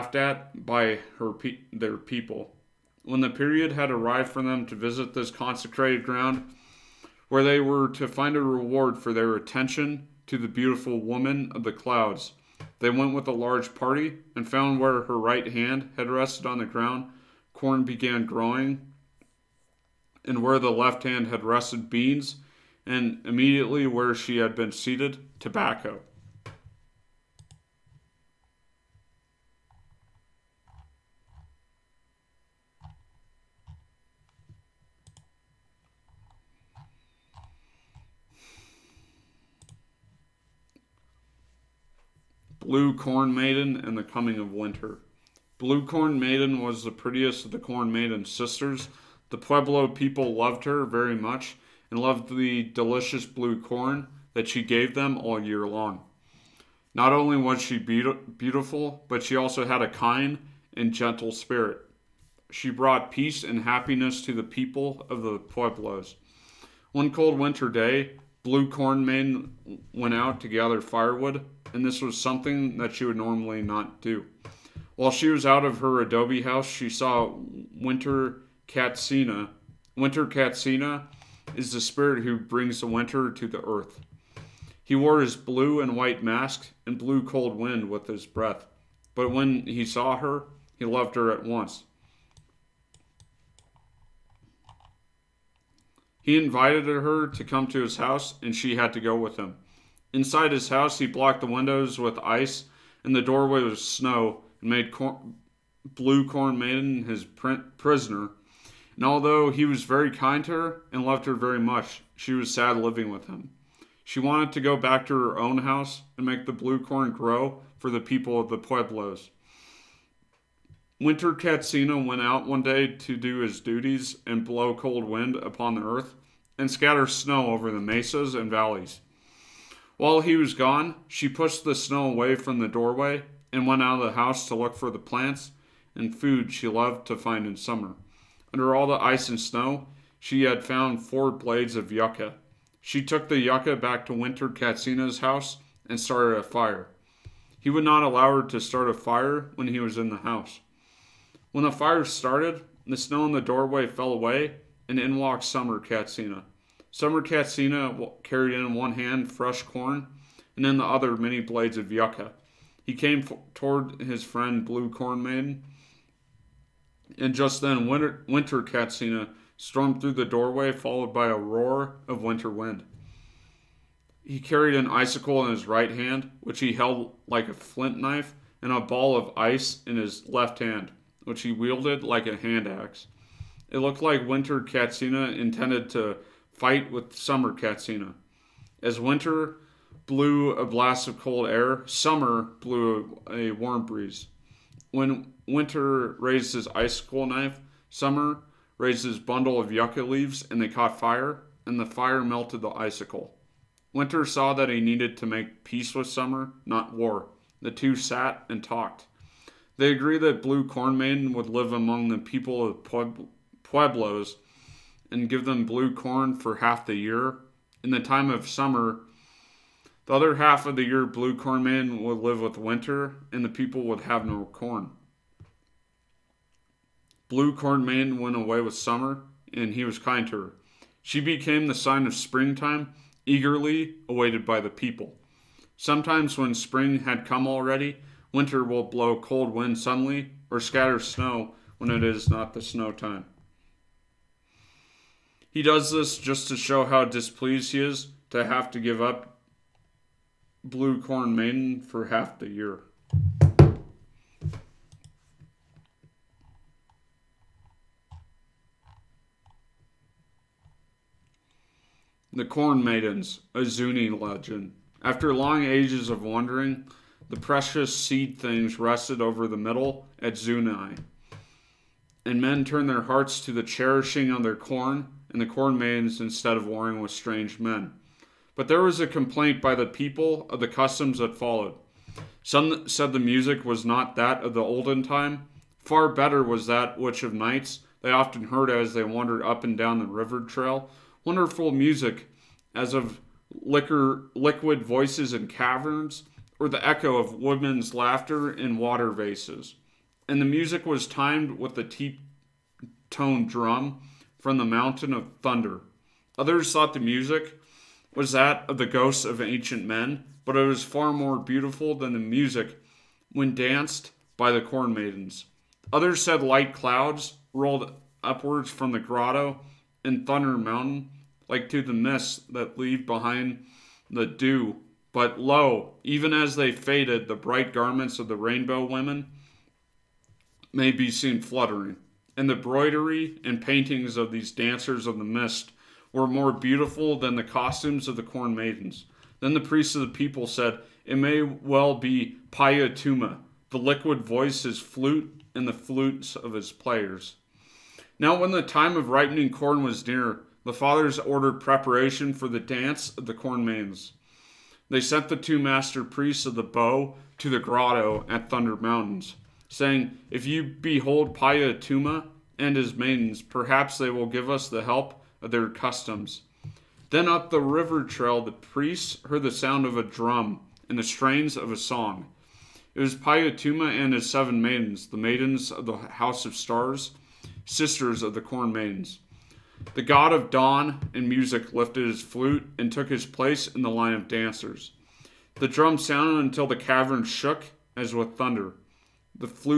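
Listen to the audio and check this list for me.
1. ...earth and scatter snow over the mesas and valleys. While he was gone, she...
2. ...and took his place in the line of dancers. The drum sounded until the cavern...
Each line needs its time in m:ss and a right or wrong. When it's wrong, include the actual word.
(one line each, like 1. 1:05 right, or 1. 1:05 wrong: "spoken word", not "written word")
1. 2:05 right
2. 6:22 right.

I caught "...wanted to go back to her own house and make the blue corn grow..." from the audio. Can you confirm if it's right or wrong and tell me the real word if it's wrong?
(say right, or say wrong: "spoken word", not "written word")
right.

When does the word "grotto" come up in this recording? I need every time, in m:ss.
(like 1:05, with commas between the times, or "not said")
5:18, 5:57.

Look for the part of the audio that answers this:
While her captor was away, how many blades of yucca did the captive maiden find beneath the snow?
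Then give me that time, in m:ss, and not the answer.
2:21.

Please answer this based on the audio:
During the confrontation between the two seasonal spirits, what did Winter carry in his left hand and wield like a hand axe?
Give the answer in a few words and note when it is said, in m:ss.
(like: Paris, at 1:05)
A ball of ice, at 2:58.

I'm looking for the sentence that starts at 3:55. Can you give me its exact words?
Sometimes, when spring had come already, Winter will blow cold winds suddenly or scatter snow when it is not the snow time.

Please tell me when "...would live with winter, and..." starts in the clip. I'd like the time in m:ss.
3:42.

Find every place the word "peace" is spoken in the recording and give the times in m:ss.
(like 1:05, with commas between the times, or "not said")
1:03, 3:25.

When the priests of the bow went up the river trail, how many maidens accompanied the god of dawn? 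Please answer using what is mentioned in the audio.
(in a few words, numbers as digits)
7.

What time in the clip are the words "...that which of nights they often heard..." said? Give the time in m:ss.
4:46.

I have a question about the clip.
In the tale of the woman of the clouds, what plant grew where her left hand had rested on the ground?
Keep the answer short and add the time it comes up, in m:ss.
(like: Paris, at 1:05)
Beans, at 0:21.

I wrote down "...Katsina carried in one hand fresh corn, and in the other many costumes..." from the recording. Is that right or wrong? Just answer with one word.
wrong.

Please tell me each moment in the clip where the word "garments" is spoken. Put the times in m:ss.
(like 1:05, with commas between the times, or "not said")
5:27.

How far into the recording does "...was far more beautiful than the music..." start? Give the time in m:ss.
5:10.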